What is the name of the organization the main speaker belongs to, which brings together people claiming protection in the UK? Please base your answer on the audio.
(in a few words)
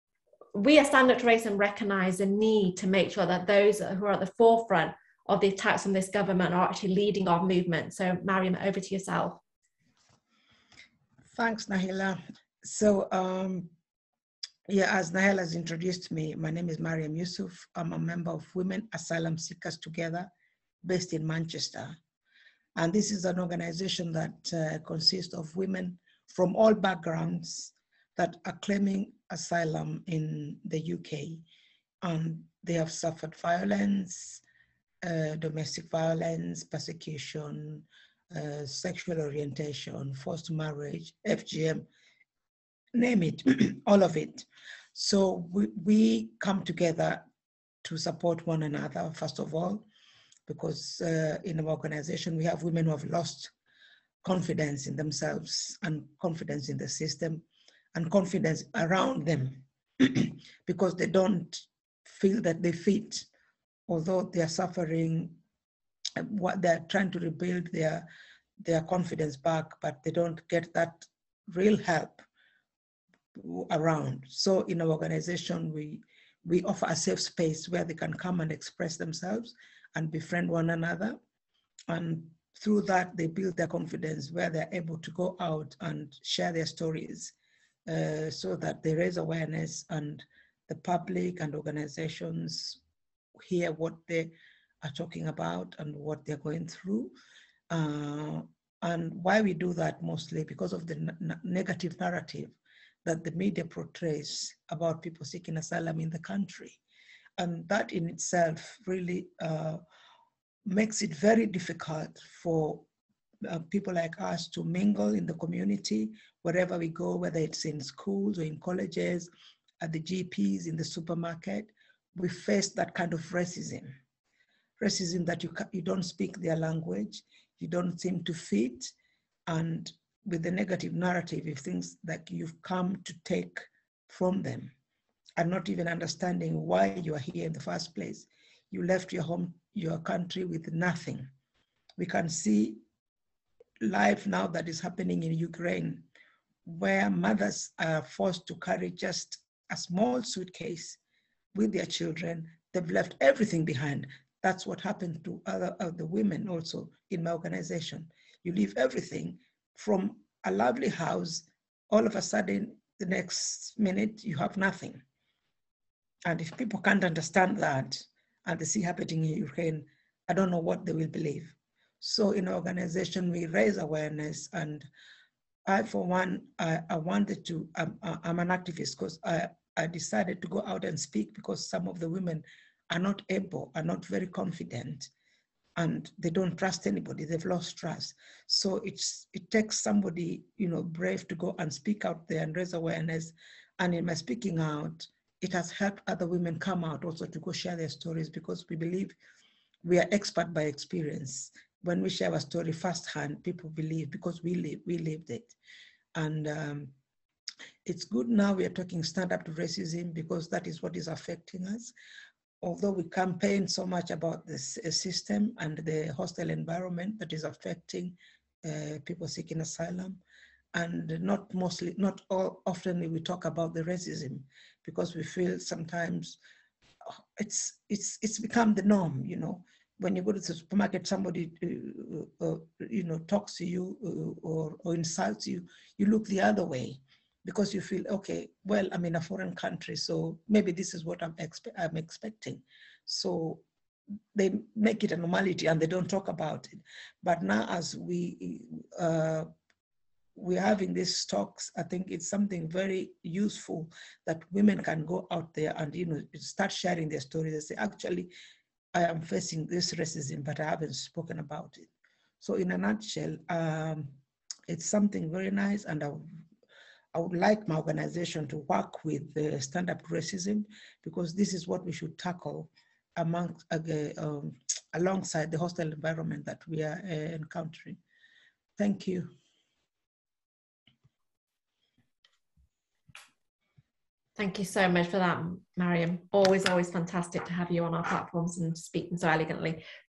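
Women Asylum Seekers Together.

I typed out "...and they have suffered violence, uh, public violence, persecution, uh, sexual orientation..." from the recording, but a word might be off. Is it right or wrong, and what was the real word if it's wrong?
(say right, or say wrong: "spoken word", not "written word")
wrong: "domestic", not "public".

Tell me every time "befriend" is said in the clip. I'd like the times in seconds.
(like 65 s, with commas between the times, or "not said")
80 s.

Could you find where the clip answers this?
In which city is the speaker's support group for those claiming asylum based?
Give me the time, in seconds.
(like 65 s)
21 s.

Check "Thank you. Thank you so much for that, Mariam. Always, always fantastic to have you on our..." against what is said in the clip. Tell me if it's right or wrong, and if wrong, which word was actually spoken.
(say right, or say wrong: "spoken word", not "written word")
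right.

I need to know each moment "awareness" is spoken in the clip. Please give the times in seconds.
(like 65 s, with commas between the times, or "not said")
89 s, 173 s, 192 s.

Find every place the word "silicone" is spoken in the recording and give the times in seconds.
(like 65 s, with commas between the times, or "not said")
not said.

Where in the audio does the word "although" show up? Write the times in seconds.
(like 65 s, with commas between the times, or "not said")
63 s, 212 s.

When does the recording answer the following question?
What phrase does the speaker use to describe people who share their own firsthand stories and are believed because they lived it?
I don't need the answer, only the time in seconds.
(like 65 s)
200 s.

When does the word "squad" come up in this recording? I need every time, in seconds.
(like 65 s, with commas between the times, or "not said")
not said.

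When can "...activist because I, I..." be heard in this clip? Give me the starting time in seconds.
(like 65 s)
178 s.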